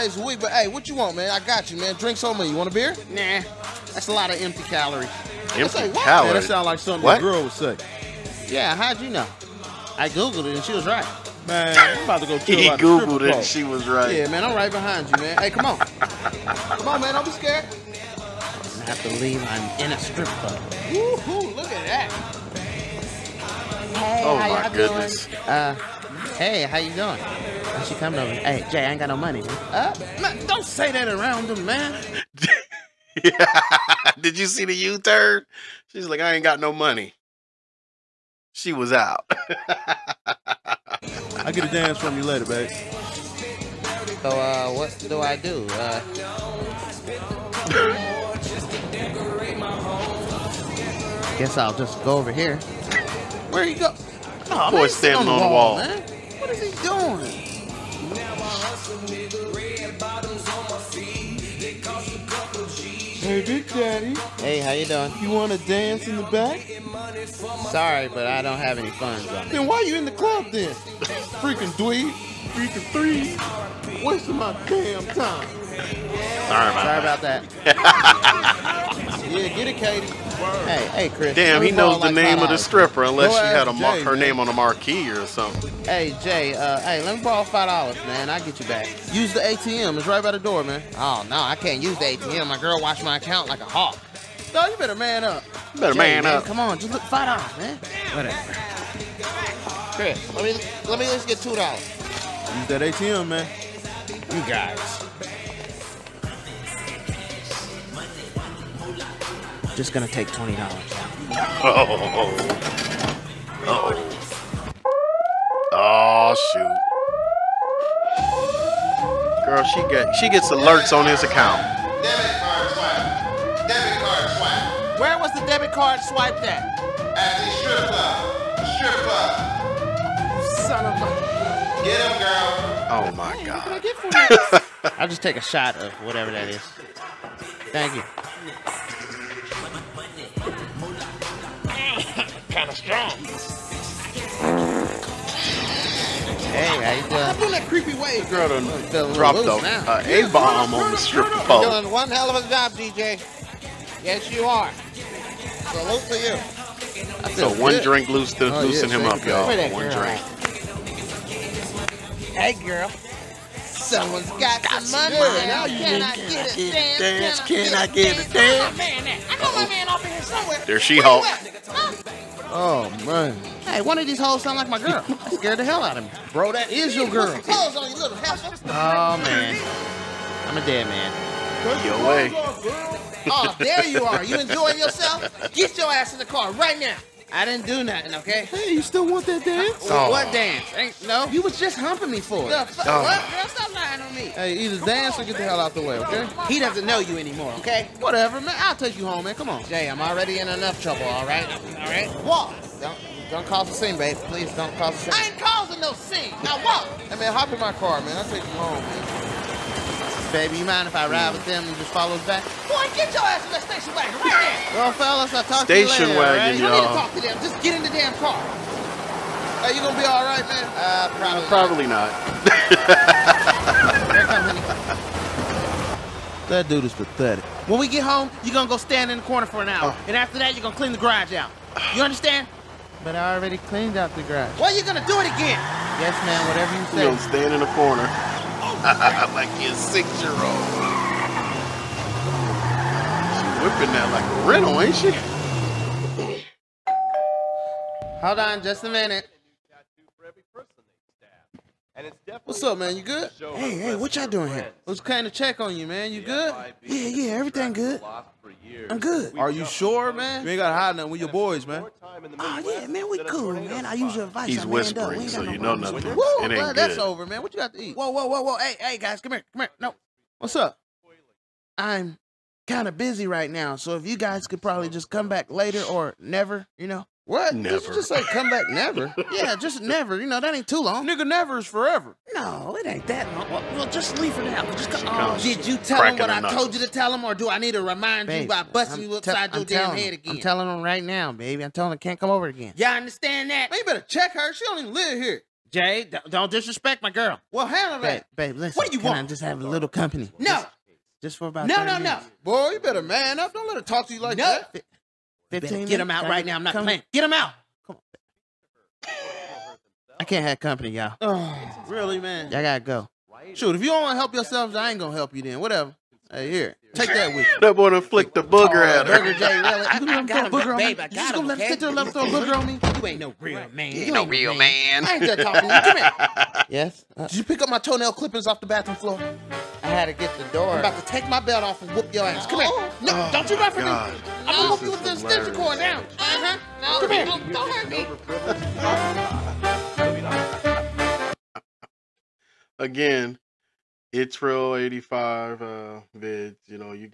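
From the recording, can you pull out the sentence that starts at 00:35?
She's like, I ain't got no money.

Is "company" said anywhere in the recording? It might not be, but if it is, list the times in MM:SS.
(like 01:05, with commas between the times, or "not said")
04:59, 05:10.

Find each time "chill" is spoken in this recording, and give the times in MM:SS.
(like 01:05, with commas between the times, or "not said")
00:12.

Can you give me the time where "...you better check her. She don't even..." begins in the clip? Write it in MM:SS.
04:53.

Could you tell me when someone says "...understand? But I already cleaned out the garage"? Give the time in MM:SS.
03:52.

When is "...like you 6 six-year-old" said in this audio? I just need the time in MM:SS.
03:58.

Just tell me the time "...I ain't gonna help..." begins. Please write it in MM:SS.
05:14.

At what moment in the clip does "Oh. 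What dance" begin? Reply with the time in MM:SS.
03:09.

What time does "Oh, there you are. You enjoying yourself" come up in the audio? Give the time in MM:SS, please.
03:03.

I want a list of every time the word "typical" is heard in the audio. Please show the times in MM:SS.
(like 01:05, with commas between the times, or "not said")
not said.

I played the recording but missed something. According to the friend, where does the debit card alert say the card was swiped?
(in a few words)
At the strip club.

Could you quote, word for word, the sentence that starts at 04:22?
Oh yeah, man, we cool, man.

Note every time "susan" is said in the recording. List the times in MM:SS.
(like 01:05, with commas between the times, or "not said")
not said.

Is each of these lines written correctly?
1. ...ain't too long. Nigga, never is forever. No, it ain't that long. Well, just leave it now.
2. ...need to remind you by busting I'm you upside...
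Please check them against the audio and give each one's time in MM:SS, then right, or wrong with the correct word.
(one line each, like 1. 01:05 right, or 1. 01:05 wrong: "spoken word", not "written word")
1. 04:40 right
2. 04:47 right.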